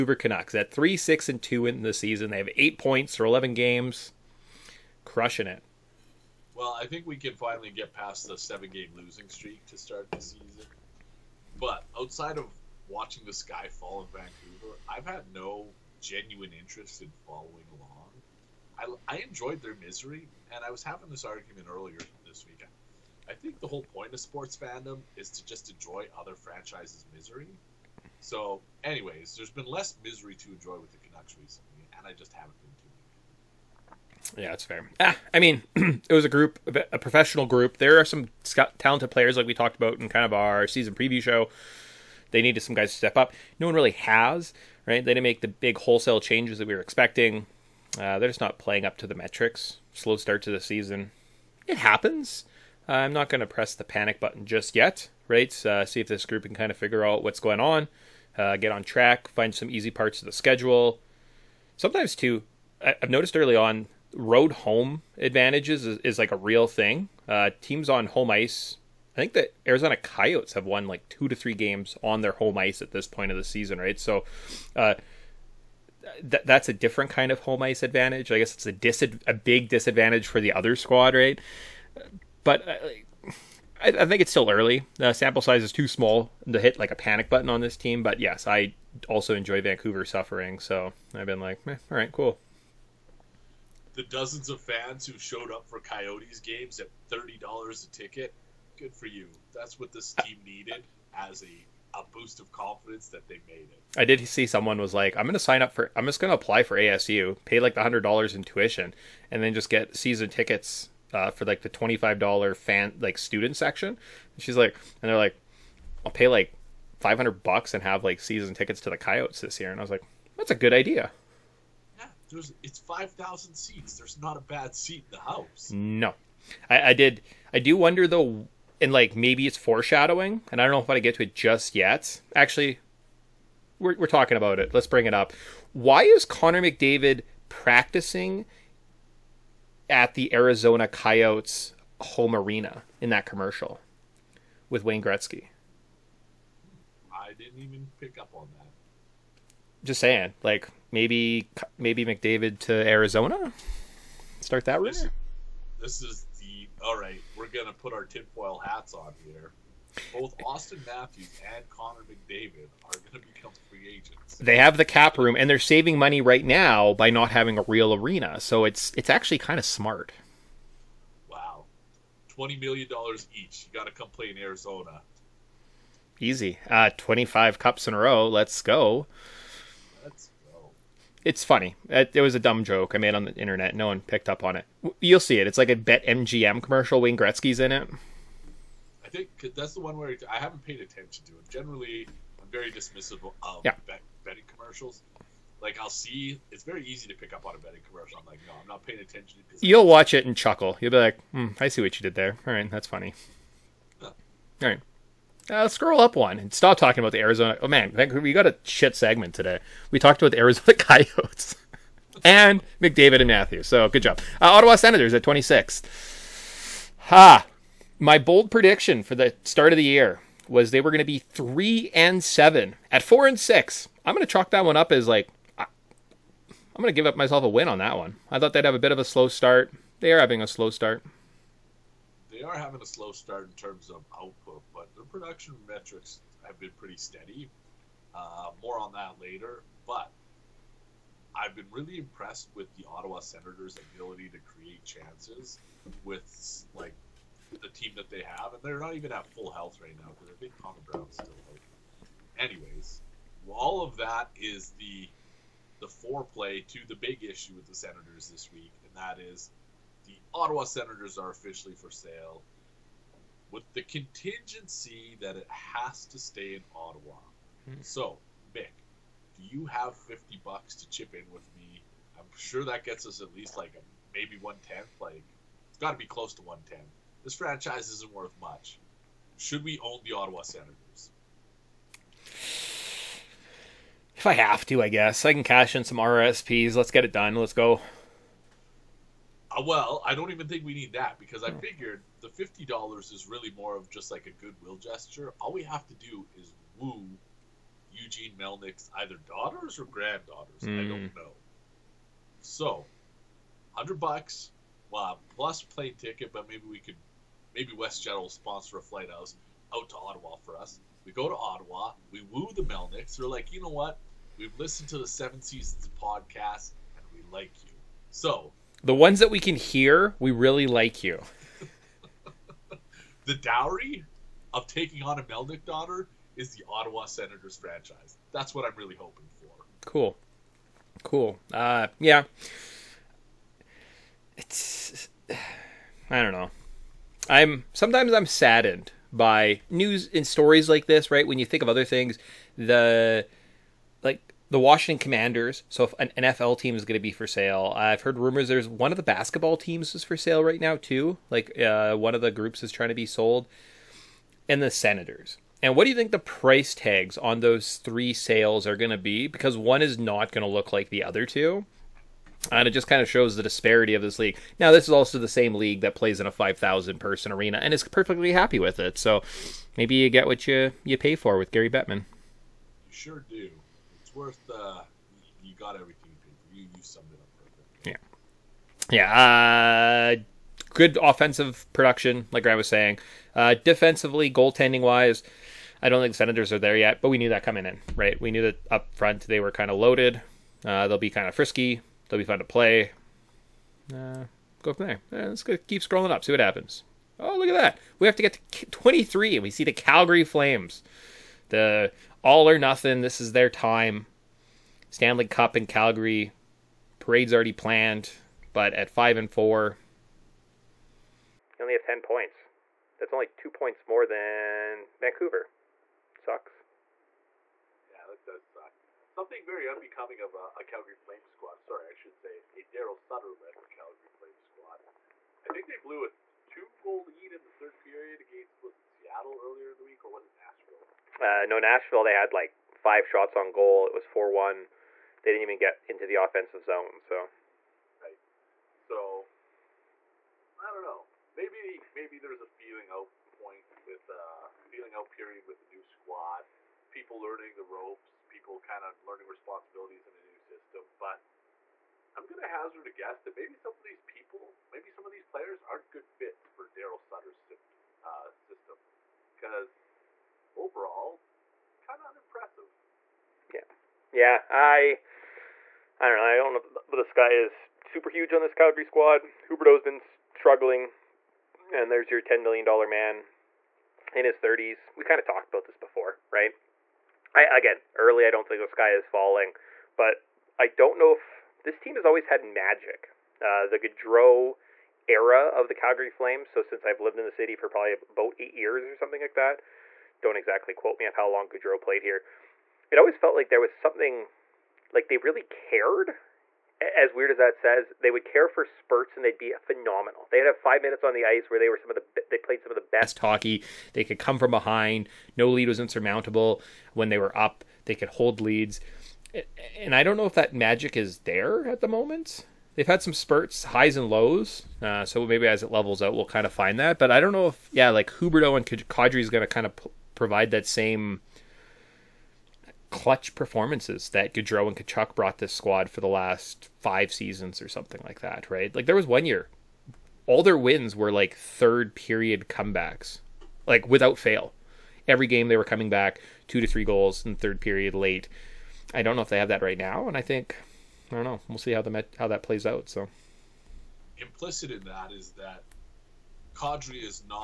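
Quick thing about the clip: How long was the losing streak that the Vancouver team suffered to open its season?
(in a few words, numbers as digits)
7 games.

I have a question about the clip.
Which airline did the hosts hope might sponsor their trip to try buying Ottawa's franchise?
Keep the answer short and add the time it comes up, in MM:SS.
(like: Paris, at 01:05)
WestJet, at 05:07.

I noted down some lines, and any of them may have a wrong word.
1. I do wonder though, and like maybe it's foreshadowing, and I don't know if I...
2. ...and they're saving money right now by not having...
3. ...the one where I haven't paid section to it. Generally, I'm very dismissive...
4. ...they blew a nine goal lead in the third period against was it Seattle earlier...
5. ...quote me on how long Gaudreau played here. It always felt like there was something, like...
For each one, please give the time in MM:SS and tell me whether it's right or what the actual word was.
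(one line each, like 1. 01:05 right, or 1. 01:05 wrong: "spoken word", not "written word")
1. 02:07 right
2. 02:45 right
3. 03:09 wrong: "attention", not "section"
4. 07:05 wrong: "two", not "nine"
5. 08:10 right.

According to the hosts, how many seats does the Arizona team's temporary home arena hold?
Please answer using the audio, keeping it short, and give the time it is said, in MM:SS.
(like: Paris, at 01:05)
5,000, at 02:02.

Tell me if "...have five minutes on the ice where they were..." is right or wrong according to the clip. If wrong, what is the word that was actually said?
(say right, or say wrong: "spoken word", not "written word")
right.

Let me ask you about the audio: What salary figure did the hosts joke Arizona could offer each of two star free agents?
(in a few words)
$20 million.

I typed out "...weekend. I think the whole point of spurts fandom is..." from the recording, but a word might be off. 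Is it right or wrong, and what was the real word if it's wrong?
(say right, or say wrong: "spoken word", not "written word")
wrong: "sports", not "spurts".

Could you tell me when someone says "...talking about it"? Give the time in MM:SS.
02:14.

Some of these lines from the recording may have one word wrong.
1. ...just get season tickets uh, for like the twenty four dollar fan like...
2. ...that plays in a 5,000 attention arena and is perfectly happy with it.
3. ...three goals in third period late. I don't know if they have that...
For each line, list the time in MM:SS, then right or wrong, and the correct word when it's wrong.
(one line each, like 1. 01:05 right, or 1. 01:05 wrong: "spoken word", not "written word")
1. 01:49 wrong: "five", not "four"
2. 06:05 wrong: "person", not "attention"
3. 08:56 right.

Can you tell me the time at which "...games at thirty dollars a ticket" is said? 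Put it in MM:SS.
01:36.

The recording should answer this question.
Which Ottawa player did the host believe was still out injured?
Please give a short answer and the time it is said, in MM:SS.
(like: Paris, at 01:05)
Connor Brown, at 04:10.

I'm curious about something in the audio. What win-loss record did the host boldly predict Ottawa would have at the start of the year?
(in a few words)
3 and 7.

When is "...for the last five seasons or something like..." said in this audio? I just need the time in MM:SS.
08:45.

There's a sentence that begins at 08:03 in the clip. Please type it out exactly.
Uh, the Gaudreau era of the Calgary Flames.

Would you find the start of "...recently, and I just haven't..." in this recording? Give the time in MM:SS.
00:31.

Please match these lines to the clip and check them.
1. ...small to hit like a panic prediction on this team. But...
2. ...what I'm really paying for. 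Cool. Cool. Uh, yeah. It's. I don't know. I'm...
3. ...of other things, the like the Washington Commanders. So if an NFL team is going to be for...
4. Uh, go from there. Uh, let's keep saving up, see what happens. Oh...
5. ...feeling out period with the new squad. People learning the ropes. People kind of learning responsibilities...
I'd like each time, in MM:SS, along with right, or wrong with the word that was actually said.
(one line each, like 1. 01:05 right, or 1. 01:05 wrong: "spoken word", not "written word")
1. 01:25 wrong: "button", not "prediction"
2. 05:28 wrong: "hoping", not "paying"
3. 05:41 right
4. 06:33 wrong: "scrolling", not "saving"
5. 07:24 right.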